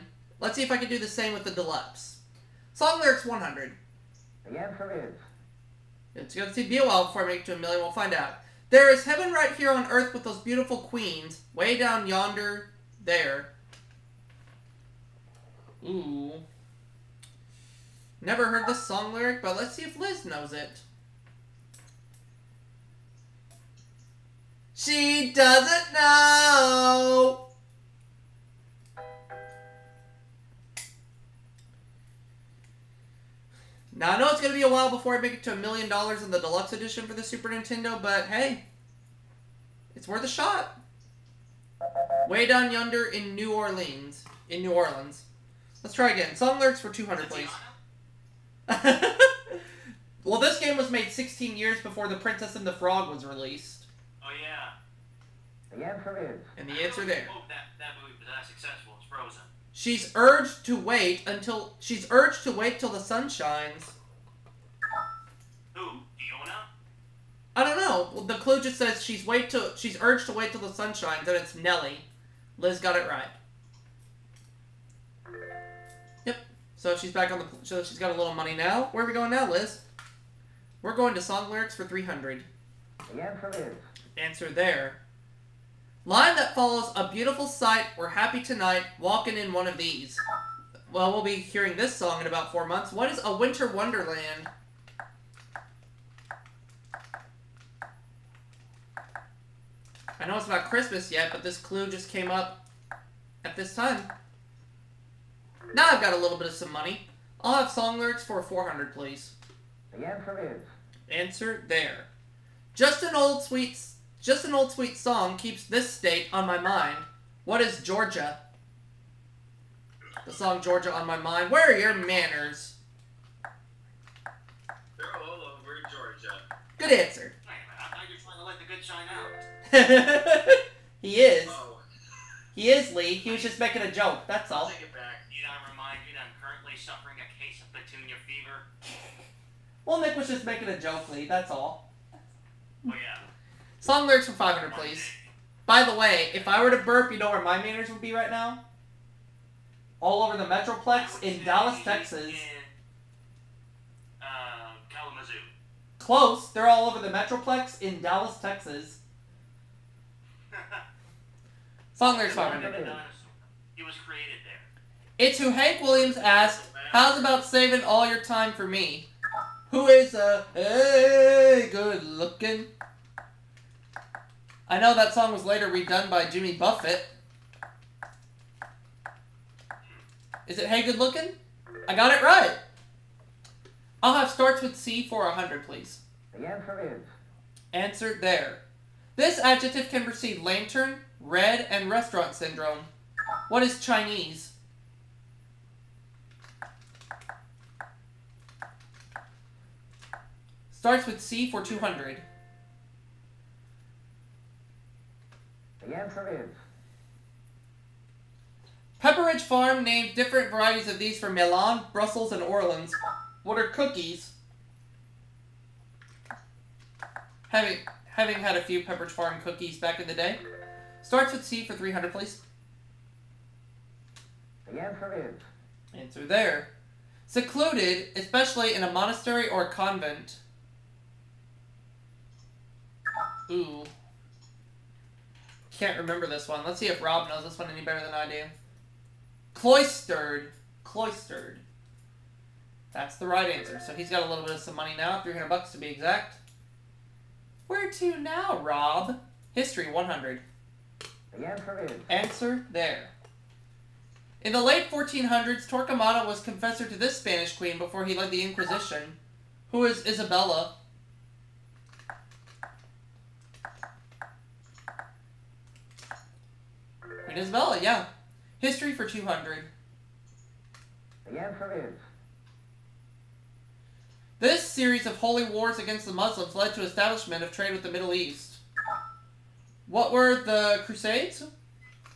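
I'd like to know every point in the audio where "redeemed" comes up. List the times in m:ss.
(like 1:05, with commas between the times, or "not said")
not said.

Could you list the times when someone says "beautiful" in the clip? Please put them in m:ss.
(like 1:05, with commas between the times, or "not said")
0:10, 1:27.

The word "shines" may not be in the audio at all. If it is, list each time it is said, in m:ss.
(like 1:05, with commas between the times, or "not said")
1:03, 1:10, 2:10.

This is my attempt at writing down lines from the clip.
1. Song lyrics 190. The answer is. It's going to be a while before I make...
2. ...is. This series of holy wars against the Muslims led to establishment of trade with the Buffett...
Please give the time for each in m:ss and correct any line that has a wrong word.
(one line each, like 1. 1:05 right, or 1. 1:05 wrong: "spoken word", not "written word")
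1. 0:02 wrong: "100", not "190"
2. 4:31 wrong: "Middle", not "Buffett".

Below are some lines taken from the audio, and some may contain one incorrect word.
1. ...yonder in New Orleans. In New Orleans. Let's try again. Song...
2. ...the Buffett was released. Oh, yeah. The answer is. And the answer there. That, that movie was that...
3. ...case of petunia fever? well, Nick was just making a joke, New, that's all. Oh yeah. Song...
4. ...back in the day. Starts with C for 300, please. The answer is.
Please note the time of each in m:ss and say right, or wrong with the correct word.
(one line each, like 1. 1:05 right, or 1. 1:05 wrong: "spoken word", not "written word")
1. 0:42 right
2. 0:52 wrong: "Frog", not "Buffett"
3. 2:17 wrong: "Lee", not "New"
4. 3:39 right.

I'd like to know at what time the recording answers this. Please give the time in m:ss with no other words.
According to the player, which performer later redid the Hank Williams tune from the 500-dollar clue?
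2:56.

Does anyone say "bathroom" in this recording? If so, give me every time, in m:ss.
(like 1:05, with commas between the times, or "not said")
not said.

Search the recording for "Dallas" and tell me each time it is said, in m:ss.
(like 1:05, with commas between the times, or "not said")
2:31, 2:38.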